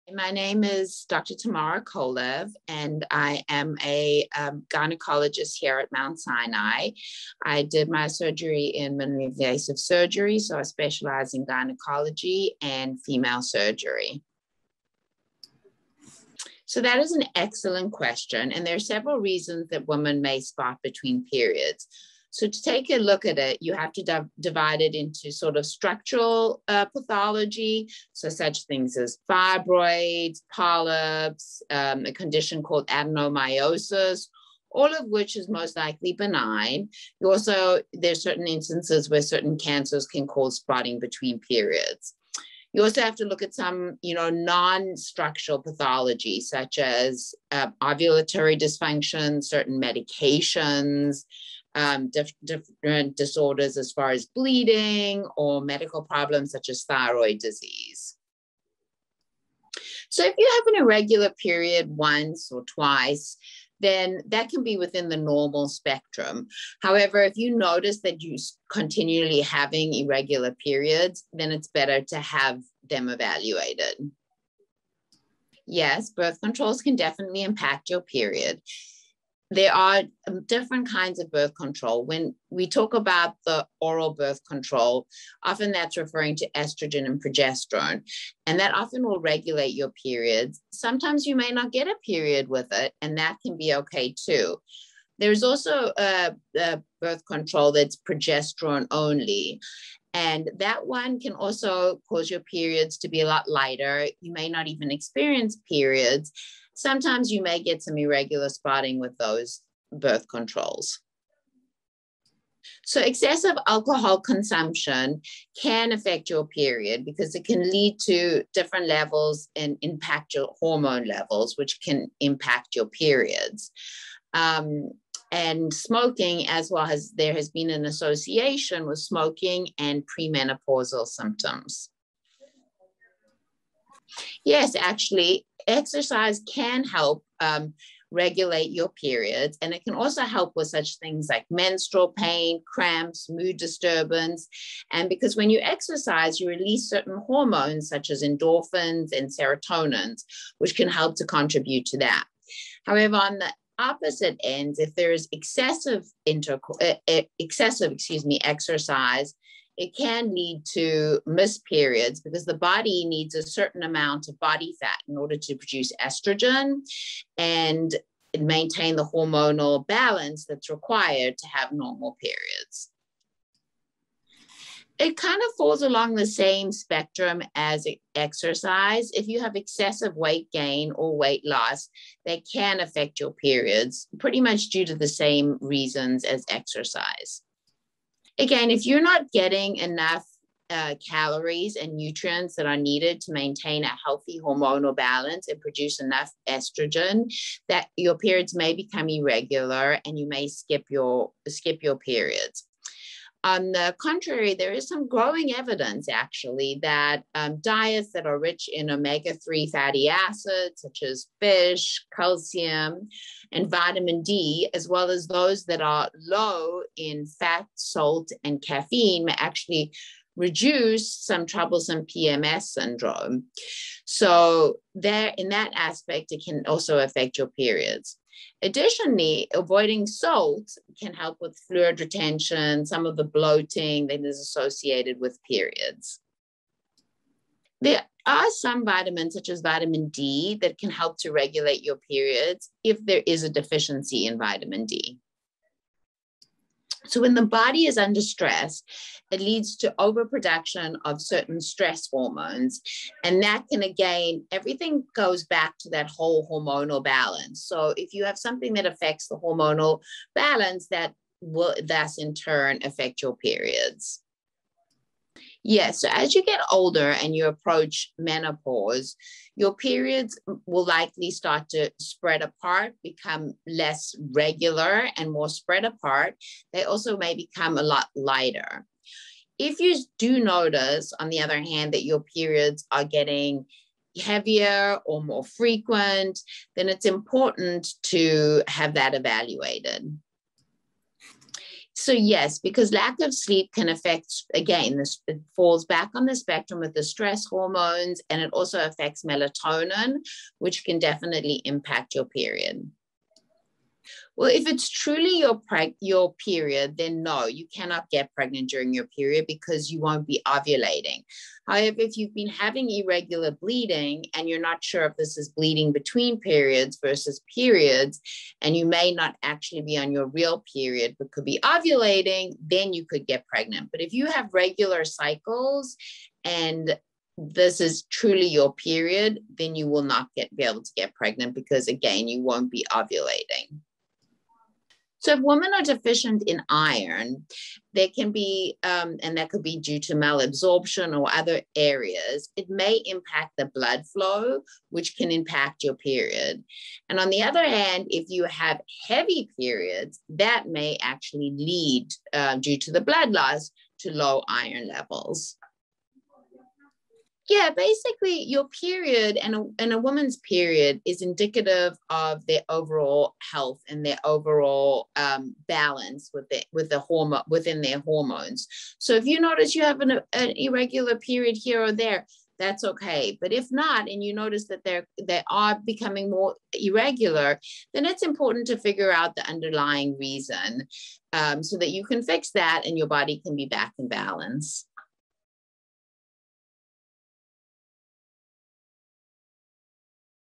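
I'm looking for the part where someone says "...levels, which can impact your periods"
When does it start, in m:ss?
2:01.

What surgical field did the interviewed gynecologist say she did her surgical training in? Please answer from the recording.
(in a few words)
Minimally invasive surgery.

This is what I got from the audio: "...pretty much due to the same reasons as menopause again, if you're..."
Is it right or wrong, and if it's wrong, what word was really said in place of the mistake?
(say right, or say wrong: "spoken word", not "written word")
wrong: "exercise", not "menopause".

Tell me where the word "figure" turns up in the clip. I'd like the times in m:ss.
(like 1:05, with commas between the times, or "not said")
6:18.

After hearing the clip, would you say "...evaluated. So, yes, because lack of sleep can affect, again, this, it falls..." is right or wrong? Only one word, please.
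right.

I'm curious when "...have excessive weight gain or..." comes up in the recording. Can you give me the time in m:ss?
2:59.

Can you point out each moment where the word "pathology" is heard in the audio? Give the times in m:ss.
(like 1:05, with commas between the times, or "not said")
0:26, 0:45.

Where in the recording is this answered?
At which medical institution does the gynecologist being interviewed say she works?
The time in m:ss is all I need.
0:05.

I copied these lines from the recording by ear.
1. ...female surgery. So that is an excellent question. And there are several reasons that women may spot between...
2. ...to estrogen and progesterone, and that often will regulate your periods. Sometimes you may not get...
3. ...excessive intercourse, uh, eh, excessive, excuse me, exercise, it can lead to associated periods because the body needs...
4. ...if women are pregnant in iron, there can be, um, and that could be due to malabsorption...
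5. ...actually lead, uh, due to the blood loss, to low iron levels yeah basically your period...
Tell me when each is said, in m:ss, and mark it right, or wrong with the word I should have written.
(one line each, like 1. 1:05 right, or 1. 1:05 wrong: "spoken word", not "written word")
1. 0:13 right
2. 1:26 right
3. 2:35 wrong: "missed", not "associated"
4. 5:35 wrong: "deficient", not "pregnant"
5. 5:51 right.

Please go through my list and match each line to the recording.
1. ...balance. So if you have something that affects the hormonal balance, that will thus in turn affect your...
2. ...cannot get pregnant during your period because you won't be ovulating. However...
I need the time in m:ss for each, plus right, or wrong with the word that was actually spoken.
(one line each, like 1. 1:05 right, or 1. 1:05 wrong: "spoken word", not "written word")
1. 4:17 right
2. 5:07 right.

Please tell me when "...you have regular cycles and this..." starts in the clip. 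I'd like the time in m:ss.
5:24.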